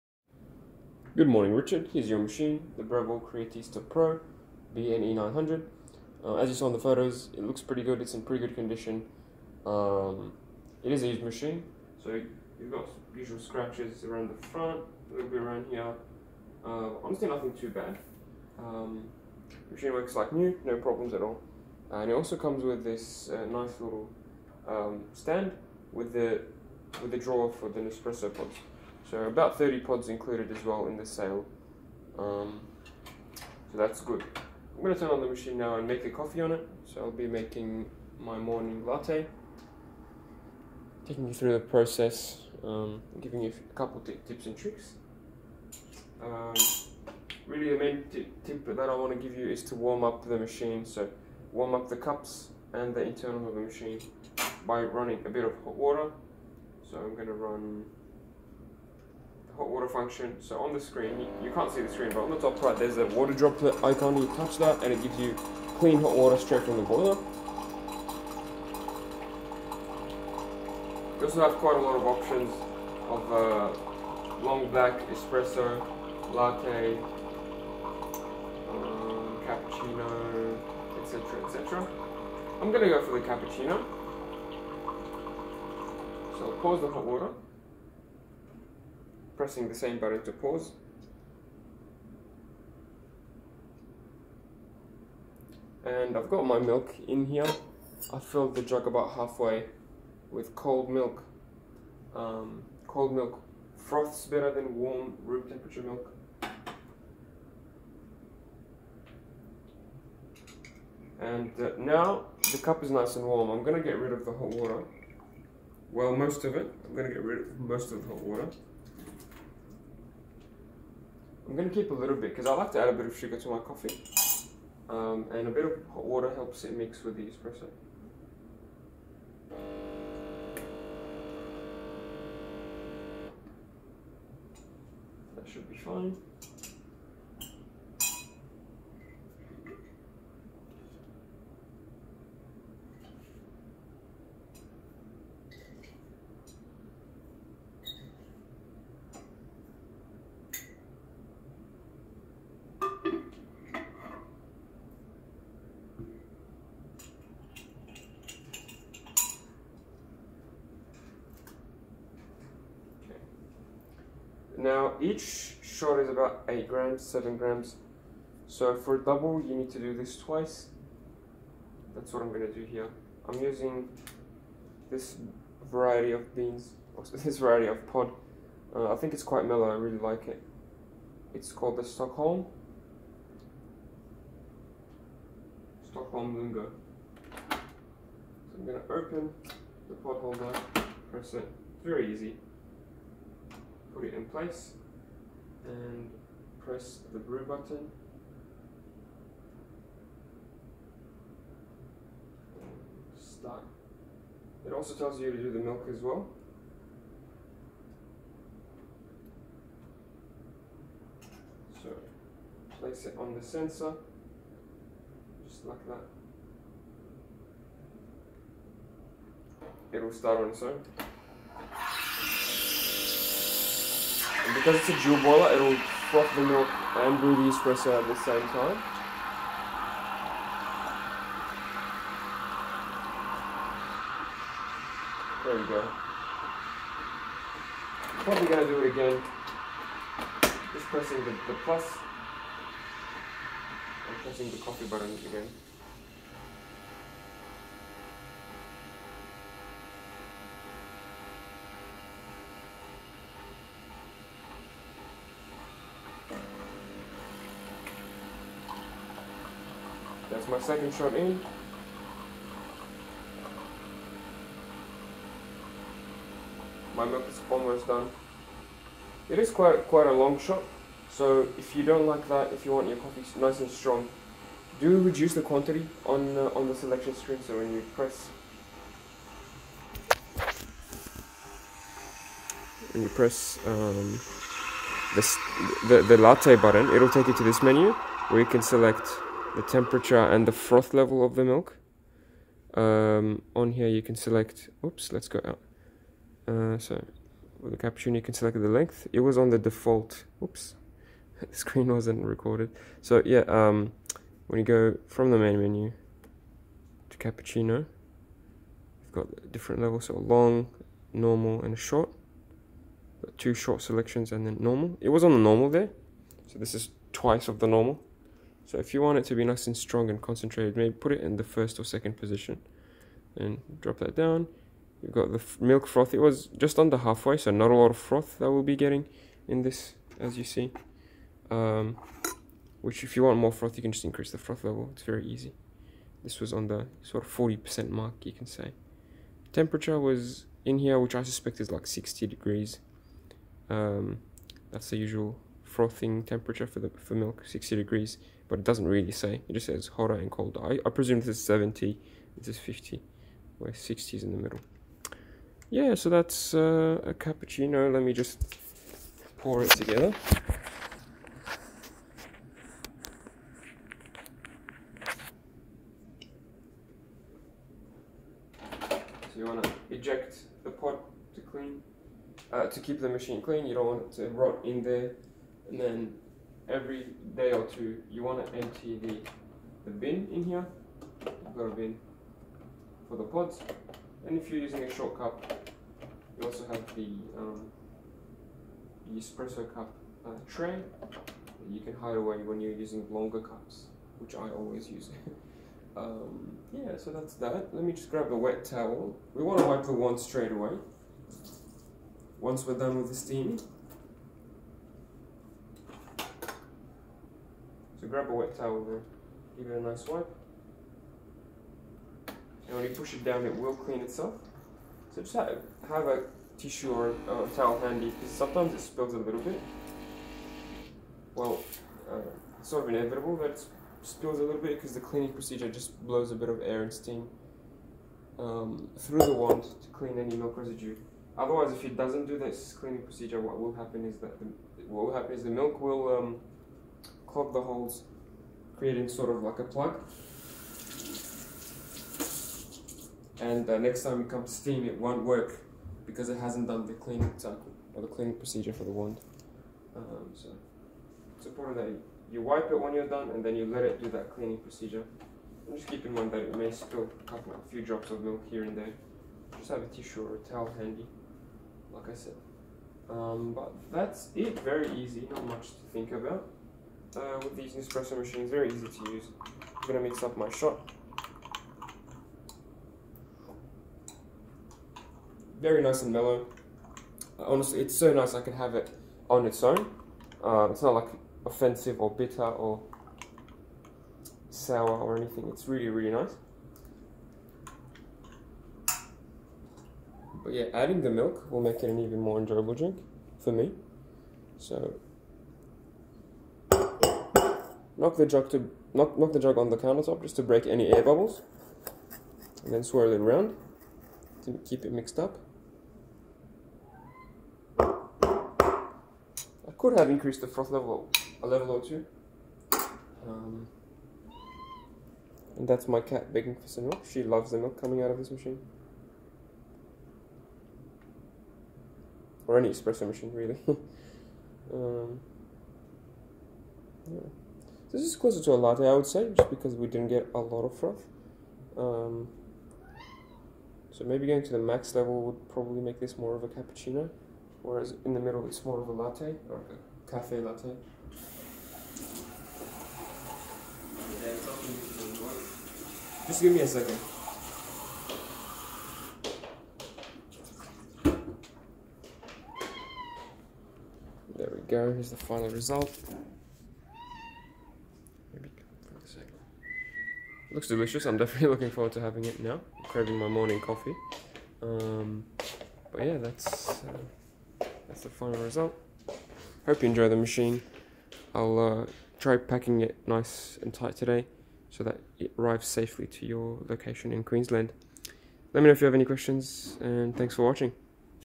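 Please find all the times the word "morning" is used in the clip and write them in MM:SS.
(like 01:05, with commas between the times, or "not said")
00:01, 00:38, 09:23.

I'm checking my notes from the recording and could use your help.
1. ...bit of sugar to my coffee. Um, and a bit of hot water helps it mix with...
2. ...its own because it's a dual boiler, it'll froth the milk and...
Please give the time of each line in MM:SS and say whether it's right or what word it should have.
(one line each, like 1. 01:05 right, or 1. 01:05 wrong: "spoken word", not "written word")
1. 02:02 right
2. 03:40 right.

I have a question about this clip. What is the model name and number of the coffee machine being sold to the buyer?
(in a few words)
Breville Creatista Pro BNE 900.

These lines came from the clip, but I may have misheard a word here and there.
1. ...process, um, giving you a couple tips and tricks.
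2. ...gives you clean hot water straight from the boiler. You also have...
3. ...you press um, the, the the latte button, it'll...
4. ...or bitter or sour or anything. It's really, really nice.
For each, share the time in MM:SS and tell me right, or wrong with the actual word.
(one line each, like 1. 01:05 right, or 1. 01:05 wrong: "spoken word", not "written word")
1. 00:41 right
2. 01:05 right
3. 04:43 right
4. 08:02 right.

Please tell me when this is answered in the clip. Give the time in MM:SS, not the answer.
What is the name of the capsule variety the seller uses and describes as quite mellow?
03:05.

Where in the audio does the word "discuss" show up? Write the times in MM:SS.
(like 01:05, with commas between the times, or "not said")
not said.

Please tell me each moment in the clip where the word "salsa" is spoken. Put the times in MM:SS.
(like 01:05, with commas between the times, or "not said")
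not said.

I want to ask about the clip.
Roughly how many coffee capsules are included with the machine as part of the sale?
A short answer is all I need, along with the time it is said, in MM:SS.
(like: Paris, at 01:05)
30, at 00:29.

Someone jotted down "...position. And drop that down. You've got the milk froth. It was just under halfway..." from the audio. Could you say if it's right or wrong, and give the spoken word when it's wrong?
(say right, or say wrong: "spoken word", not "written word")
right.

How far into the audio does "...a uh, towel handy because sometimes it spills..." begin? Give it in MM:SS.
06:57.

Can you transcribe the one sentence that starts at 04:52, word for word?
Um, on here you can select, oops, let's go out.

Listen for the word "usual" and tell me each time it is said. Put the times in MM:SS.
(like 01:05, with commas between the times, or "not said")
00:13, 05:44.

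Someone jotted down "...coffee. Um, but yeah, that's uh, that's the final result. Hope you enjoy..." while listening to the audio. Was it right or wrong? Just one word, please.
right.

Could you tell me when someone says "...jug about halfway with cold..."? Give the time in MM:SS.
01:38.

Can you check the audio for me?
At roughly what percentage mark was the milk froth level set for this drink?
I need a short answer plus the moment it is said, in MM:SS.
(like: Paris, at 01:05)
40%, at 05:37.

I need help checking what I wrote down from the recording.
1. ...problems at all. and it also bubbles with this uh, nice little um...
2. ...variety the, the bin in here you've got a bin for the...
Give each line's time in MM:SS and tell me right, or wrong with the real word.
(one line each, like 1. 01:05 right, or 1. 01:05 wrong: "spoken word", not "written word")
1. 00:20 wrong: "comes", not "bubbles"
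2. 06:18 wrong: "empty", not "variety".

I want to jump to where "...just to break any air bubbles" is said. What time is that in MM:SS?
08:20.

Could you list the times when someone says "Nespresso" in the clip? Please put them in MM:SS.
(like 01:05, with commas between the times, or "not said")
00:27, 07:47.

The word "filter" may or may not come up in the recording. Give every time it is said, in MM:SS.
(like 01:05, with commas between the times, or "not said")
not said.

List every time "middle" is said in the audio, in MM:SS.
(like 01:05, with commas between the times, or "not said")
05:54, 08:58.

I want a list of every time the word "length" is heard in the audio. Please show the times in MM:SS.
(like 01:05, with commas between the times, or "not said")
04:58.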